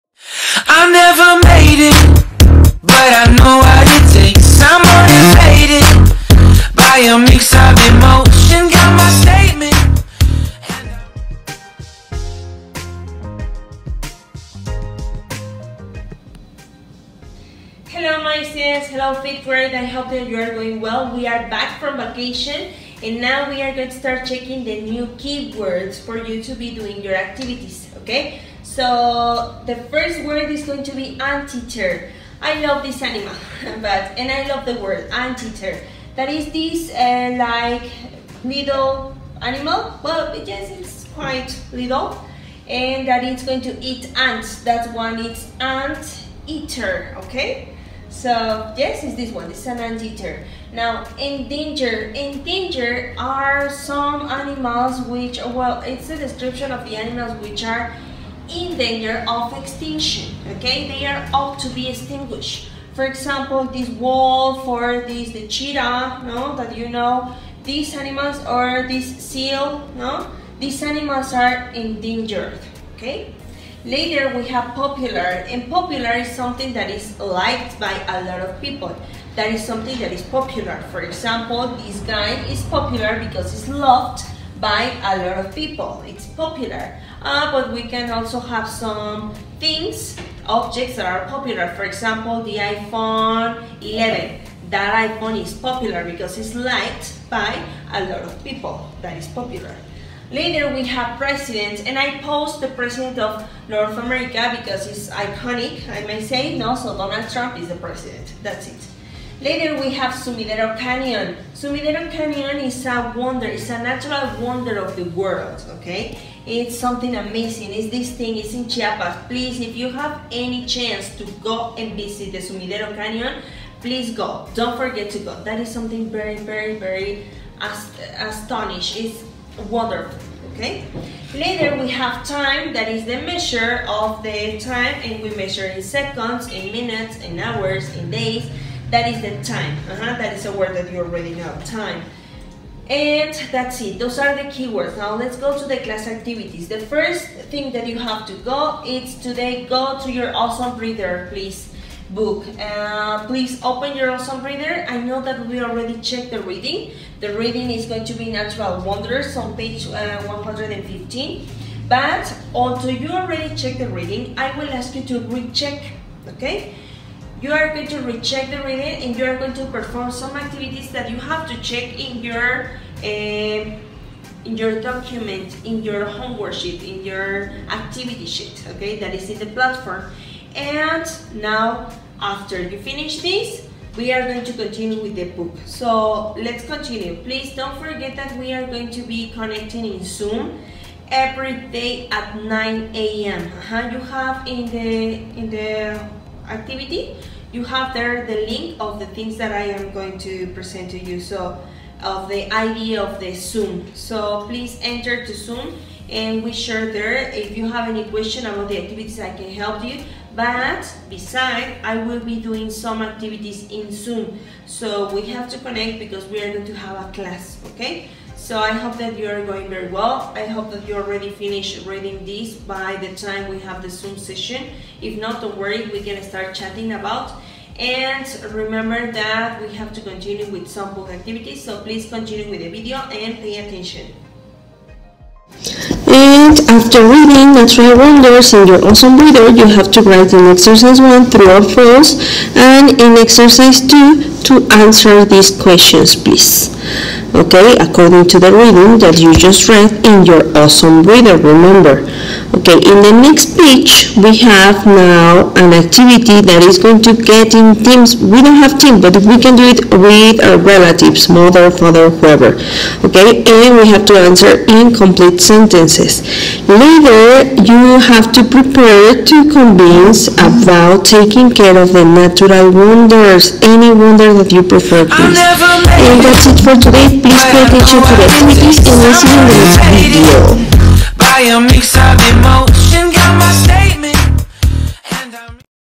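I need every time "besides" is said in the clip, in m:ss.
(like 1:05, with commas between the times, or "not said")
3:31.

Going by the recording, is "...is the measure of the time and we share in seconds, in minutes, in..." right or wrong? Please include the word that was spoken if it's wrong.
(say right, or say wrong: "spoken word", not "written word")
wrong: "measure", not "share".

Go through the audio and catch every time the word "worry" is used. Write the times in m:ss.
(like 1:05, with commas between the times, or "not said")
3:45.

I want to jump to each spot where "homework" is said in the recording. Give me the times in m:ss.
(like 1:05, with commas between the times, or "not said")
2:56.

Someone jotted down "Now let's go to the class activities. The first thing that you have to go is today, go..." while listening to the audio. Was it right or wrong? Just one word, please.
right.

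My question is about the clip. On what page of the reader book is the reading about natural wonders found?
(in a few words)
115.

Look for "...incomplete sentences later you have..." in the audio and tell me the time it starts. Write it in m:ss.
4:24.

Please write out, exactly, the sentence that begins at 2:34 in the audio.
I know that we already checked the reading.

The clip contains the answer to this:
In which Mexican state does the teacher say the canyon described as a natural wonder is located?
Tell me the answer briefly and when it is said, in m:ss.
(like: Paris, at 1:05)
Chiapas, at 1:58.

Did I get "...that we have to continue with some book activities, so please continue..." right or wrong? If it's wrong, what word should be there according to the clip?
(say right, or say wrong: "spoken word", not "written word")
right.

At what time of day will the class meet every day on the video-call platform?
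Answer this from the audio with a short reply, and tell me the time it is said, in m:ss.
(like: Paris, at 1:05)
9 a.m., at 3:12.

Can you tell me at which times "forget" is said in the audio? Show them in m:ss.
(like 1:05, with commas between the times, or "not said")
2:04, 3:07.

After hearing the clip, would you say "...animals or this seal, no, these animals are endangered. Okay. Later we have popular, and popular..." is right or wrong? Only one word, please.
right.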